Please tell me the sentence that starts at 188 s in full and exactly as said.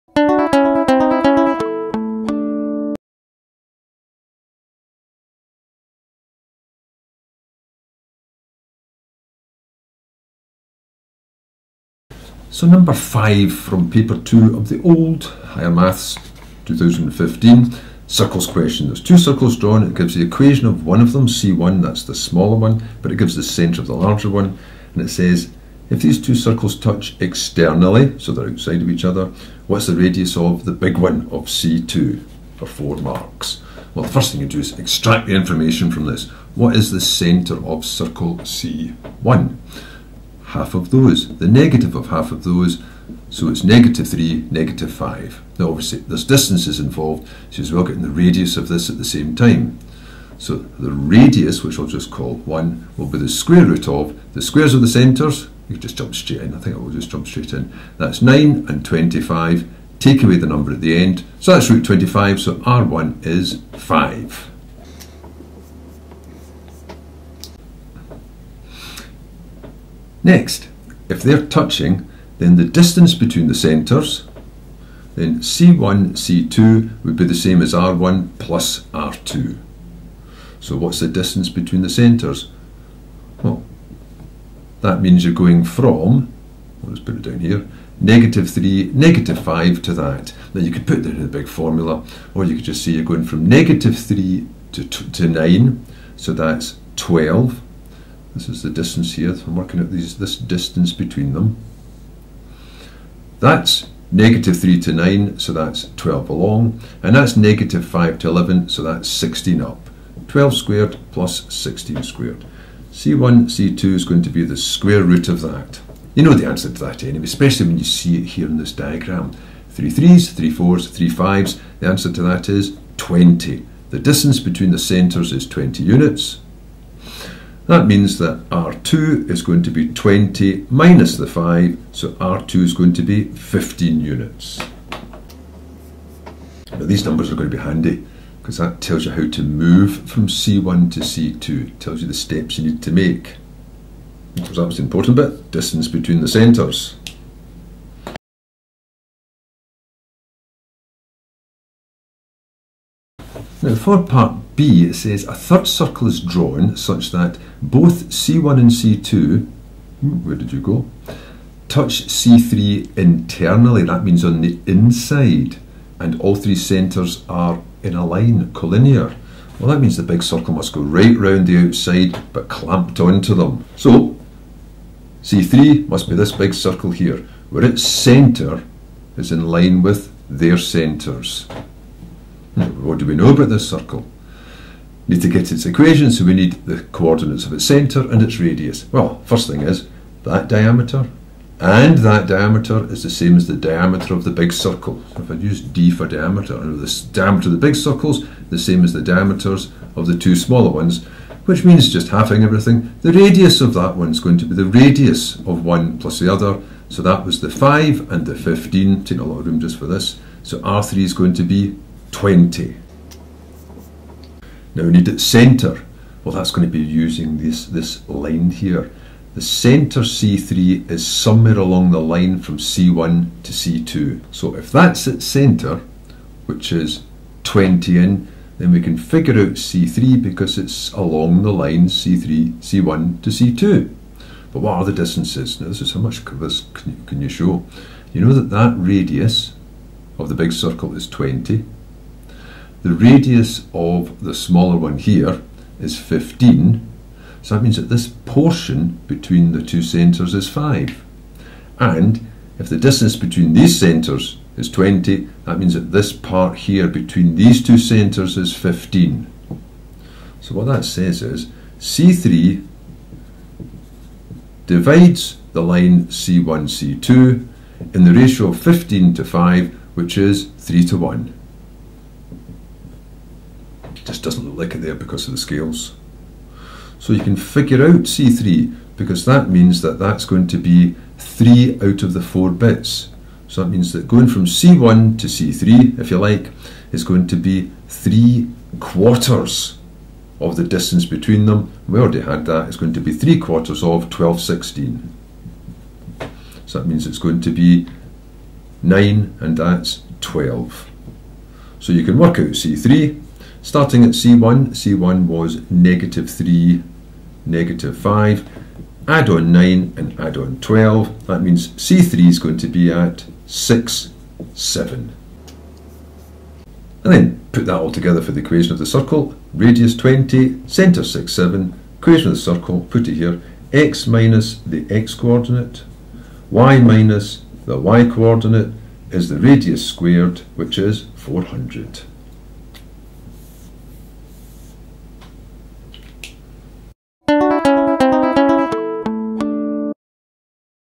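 Well, first thing is, that diameter and that diameter is the same as the diameter of the big circle.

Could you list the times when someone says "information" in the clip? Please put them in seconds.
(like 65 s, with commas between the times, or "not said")
35 s.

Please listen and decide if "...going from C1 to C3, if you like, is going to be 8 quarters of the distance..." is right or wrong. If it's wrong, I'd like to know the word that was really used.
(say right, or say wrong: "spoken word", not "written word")
wrong: "3", not "8".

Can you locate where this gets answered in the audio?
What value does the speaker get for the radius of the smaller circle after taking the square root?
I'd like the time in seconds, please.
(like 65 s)
62 s.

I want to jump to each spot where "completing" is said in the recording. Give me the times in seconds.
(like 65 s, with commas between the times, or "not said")
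not said.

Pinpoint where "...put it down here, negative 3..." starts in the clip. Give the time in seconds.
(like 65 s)
86 s.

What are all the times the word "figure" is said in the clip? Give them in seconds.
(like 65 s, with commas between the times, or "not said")
228 s, 277 s.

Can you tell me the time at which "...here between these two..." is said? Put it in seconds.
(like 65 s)
256 s.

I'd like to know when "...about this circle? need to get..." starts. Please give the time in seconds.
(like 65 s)
183 s.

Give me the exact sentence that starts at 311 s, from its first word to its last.
That means C3 is going to be at 6, 7.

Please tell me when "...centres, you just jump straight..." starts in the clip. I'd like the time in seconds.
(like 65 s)
54 s.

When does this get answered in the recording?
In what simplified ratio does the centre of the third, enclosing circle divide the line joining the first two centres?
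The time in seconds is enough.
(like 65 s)
270 s.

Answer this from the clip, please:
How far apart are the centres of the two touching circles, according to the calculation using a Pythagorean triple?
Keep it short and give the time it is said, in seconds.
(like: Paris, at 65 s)
20 units, at 125 s.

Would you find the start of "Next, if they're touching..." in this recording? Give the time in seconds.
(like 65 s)
70 s.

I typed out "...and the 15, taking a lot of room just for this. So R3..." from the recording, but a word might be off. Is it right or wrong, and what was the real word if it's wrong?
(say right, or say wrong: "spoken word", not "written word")
right.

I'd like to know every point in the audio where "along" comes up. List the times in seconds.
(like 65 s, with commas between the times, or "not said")
106 s, 221 s, 230 s.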